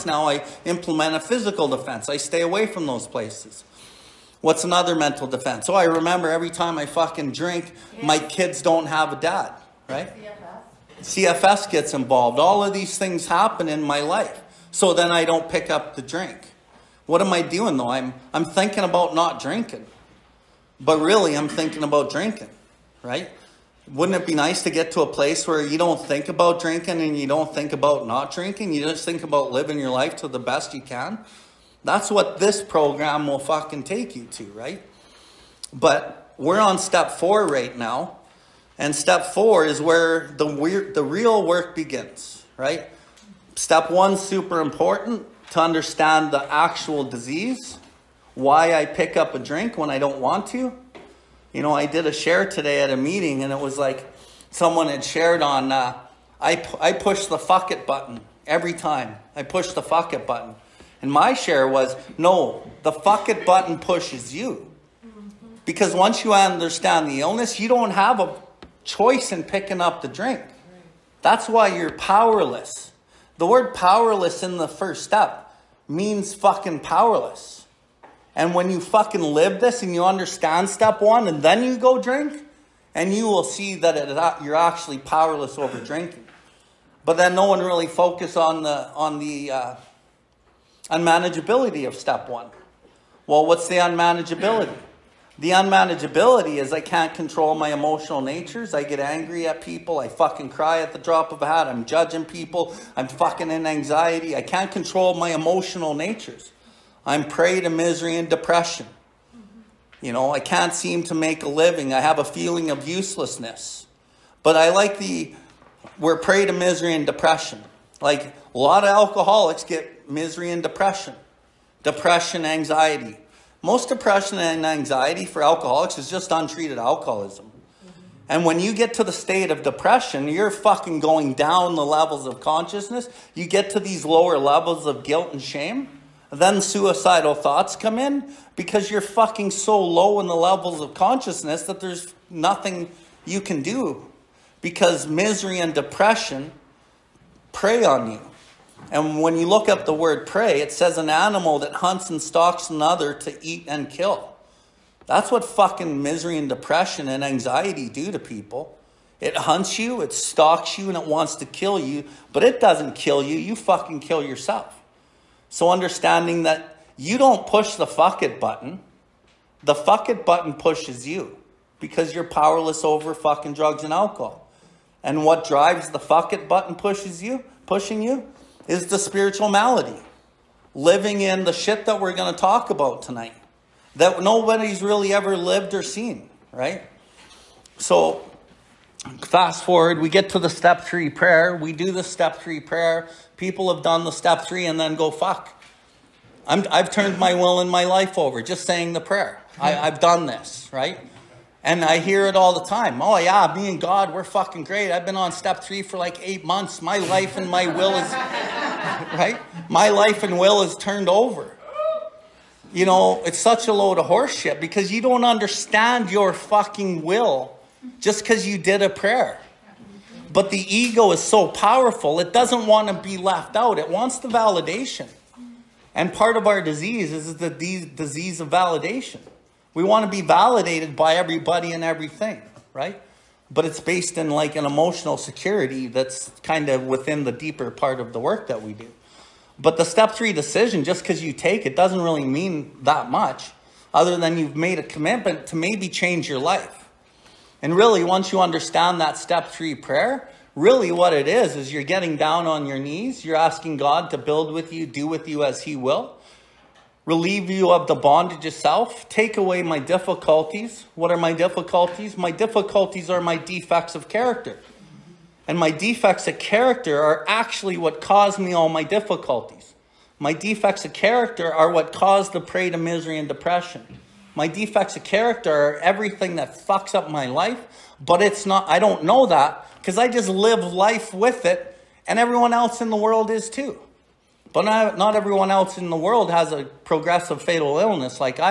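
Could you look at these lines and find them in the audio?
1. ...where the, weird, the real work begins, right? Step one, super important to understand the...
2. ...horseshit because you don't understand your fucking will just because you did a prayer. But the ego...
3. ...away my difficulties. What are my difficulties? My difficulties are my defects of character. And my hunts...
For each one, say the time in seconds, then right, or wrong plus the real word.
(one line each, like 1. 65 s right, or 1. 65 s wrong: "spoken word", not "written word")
1. 39 s right
2. 214 s right
3. 259 s wrong: "defects", not "hunts".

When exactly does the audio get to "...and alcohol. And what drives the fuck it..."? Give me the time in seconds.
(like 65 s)
173 s.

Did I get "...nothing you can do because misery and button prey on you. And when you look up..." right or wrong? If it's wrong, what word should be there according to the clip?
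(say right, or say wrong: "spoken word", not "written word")
wrong: "depression", not "button".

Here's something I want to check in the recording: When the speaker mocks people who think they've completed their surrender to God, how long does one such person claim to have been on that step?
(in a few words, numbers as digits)
8 months.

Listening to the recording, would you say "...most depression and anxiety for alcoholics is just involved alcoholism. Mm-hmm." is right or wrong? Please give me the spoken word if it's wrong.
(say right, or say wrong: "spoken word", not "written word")
wrong: "untreated", not "involved".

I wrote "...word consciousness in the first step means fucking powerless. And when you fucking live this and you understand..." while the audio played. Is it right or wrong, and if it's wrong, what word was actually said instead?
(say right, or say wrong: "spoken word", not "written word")
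wrong: "powerless", not "consciousness".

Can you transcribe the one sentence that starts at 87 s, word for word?
But then no one really focuses on the, on the uh, unmanageability of step one.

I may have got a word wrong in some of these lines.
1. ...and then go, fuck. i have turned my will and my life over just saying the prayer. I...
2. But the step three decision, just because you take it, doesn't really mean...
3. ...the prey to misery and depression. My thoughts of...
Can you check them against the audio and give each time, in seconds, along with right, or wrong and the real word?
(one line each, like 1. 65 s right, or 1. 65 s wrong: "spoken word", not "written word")
1. 194 s right
2. 239 s right
3. 272 s wrong: "defects", not "thoughts".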